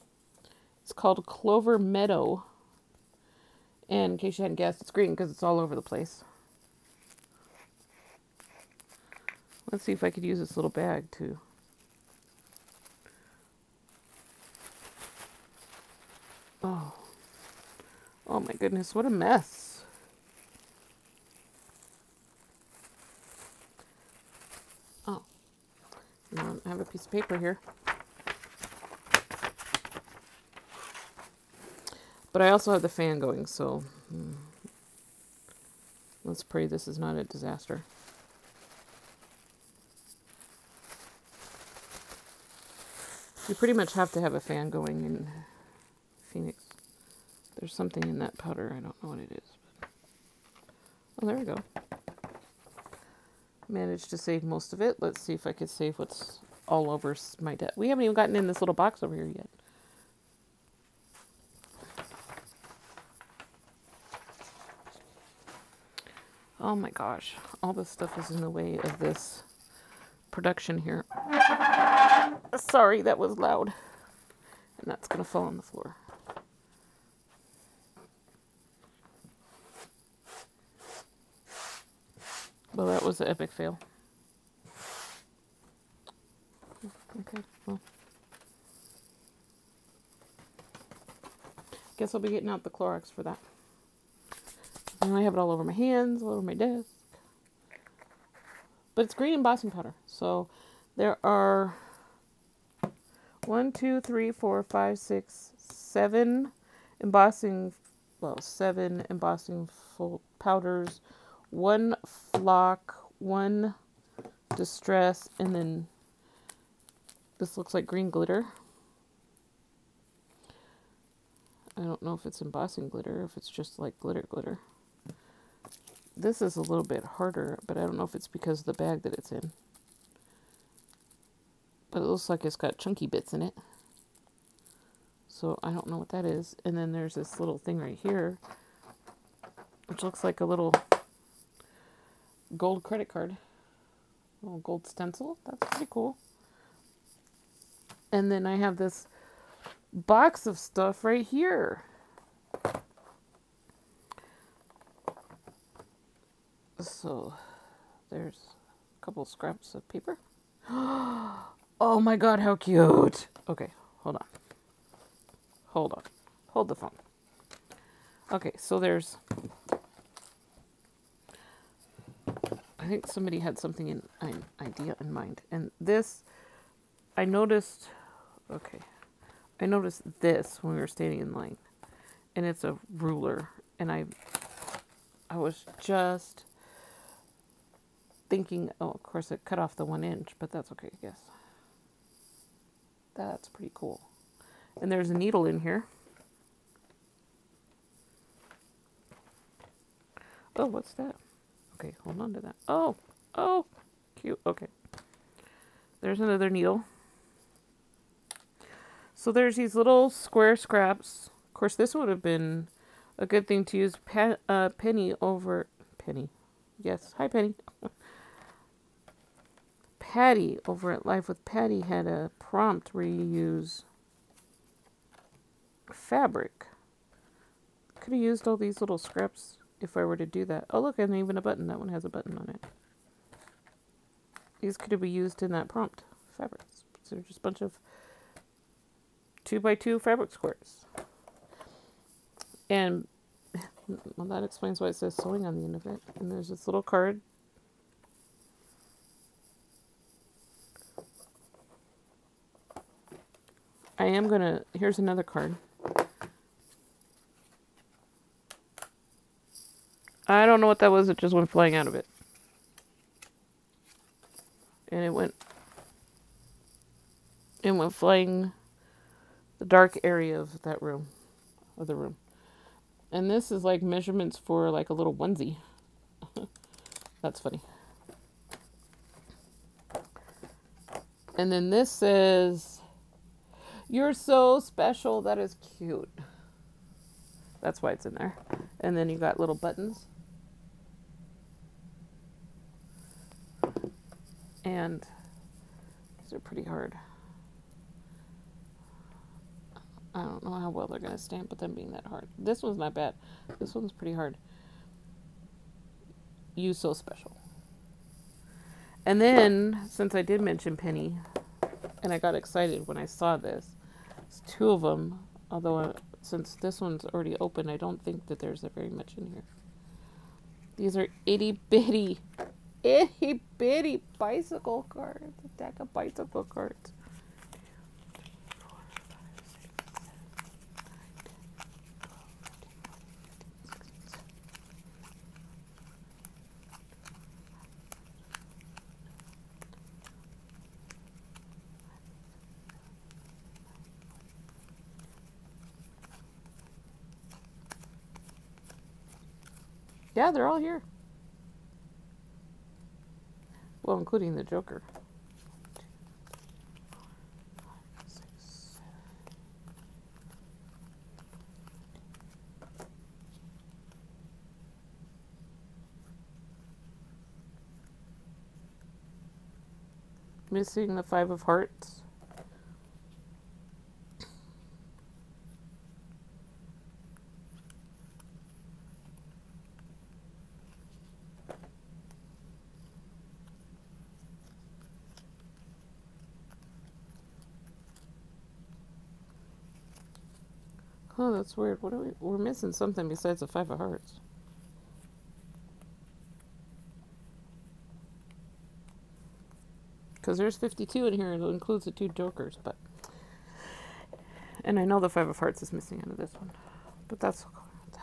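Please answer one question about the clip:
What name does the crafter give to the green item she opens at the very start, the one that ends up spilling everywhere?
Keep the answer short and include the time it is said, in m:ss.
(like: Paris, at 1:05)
Clover Meadow, at 0:01.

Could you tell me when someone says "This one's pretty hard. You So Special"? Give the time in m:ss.
5:03.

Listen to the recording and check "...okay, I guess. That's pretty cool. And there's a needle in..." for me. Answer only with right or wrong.
right.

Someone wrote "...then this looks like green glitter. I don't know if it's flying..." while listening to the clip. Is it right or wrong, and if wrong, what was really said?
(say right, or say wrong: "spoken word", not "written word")
wrong: "embossing", not "flying".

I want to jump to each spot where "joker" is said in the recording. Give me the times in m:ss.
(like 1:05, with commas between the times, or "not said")
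5:54, 6:42.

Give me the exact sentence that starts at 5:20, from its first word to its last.
These are itty bitty itty bitty bicycle cards, a deck of bicycle cards.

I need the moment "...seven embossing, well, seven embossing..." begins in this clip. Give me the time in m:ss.
1:45.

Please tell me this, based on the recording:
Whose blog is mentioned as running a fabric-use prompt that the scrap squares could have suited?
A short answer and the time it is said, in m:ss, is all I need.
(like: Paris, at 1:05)
Life with Patti, at 3:41.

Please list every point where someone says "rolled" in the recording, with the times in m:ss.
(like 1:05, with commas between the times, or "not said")
not said.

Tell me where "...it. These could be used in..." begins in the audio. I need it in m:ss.
3:52.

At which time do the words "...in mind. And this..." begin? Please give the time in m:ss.
2:54.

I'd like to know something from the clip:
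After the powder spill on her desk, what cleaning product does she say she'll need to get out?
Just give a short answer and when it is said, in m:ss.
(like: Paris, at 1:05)
Clorox, at 1:32.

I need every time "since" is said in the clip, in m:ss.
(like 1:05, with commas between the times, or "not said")
5:09, 5:16.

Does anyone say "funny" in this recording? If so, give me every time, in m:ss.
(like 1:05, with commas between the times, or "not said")
4:37.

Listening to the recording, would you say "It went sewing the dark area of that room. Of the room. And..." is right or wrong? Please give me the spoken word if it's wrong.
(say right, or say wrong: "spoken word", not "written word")
wrong: "flying", not "sewing".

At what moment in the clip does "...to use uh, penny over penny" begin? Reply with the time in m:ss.
3:33.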